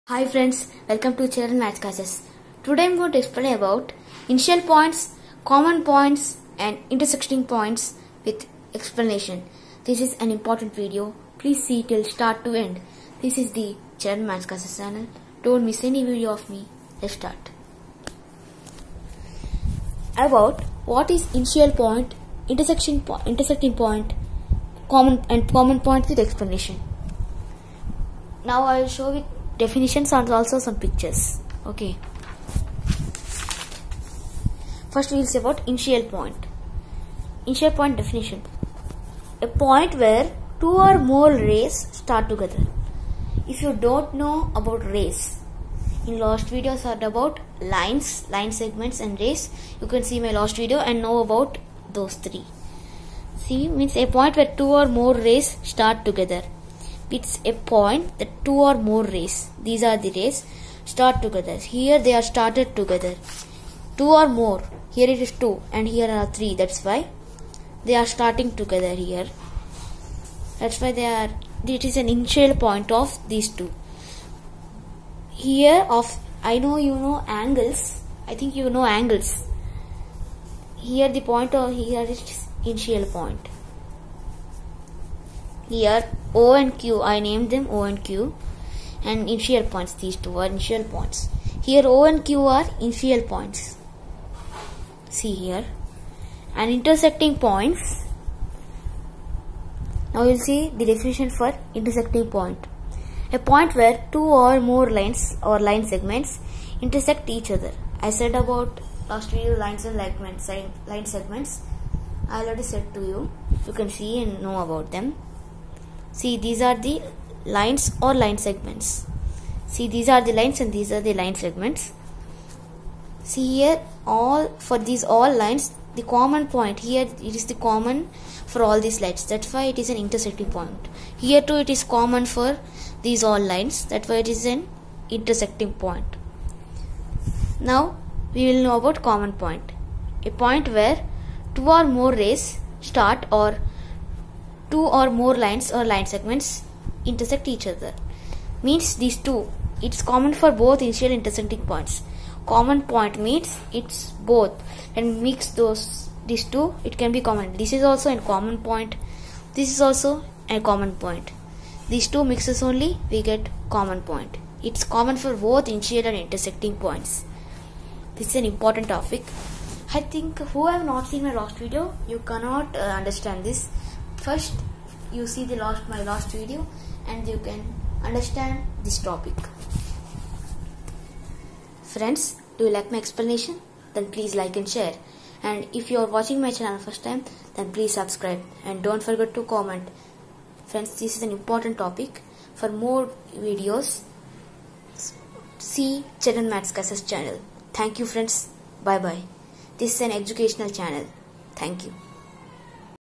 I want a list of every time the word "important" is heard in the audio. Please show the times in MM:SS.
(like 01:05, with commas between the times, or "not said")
00:10, 02:48, 03:11.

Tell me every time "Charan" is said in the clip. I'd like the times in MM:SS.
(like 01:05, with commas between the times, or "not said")
00:01, 00:13, 03:16.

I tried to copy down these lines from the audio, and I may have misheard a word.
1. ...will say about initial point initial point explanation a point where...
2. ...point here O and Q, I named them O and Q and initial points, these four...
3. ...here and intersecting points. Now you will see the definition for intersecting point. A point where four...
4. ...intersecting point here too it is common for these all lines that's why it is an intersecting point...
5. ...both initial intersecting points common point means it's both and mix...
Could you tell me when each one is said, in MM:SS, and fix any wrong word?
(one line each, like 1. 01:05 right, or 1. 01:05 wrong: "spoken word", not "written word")
1. 00:35 wrong: "definition", not "explanation"
2. 01:23 wrong: "two", not "four"
3. 01:35 wrong: "two", not "four"
4. 02:09 right
5. 02:30 right.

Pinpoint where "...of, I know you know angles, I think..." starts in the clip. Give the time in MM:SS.
01:15.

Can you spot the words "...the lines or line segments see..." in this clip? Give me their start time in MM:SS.
01:56.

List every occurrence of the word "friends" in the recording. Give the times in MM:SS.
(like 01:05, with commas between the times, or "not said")
00:00, 03:01, 03:10, 03:18.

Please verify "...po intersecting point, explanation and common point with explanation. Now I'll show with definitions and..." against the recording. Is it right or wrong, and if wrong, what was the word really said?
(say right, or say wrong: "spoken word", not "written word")
wrong: "common", not "explanation".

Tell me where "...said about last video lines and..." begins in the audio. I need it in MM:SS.
01:48.